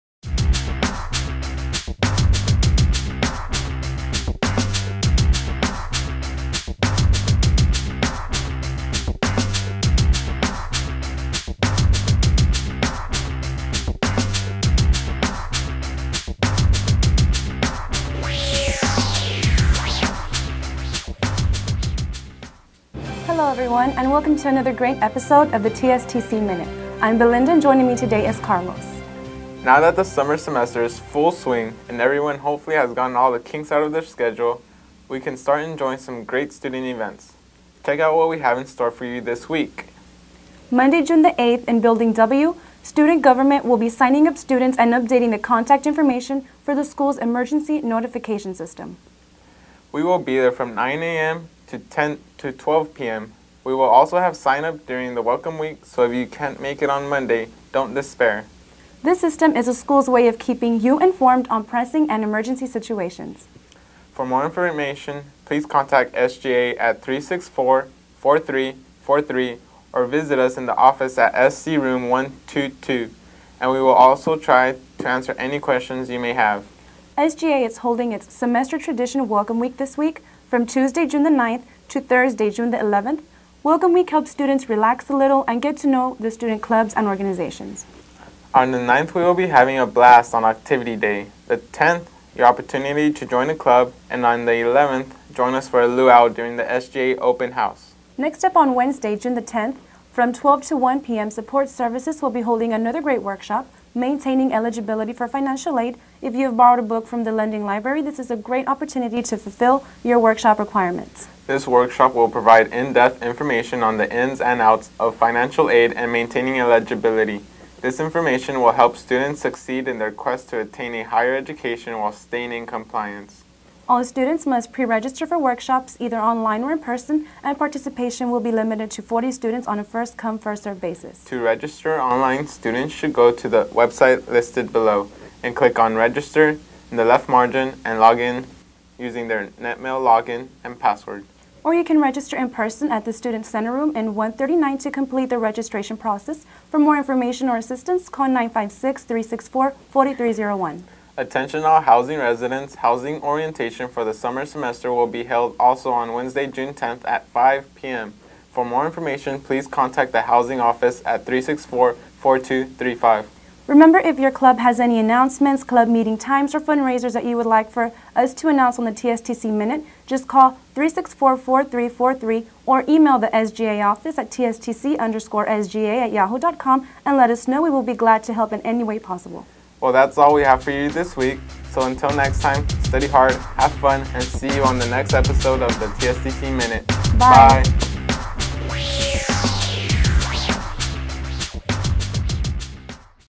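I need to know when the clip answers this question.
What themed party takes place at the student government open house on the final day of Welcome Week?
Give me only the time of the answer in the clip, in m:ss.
1:35.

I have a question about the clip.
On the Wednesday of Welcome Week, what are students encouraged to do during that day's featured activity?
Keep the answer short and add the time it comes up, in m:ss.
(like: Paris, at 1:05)
Join a club, at 1:33.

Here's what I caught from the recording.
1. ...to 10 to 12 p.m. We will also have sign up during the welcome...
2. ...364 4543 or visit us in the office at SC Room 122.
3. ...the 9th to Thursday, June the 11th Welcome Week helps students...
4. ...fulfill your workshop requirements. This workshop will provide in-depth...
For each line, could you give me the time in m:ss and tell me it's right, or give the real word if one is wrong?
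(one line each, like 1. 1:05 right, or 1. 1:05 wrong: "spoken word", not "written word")
1. 0:51 right
2. 1:07 wrong: "4343", not "4543"
3. 1:21 right
4. 1:49 right.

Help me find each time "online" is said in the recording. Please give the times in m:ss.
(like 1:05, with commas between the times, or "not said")
2:06, 2:11.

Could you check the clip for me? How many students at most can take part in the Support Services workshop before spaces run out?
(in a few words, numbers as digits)
40.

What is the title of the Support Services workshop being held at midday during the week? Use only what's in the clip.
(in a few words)
Maintaining Eligibility for Financial Aid.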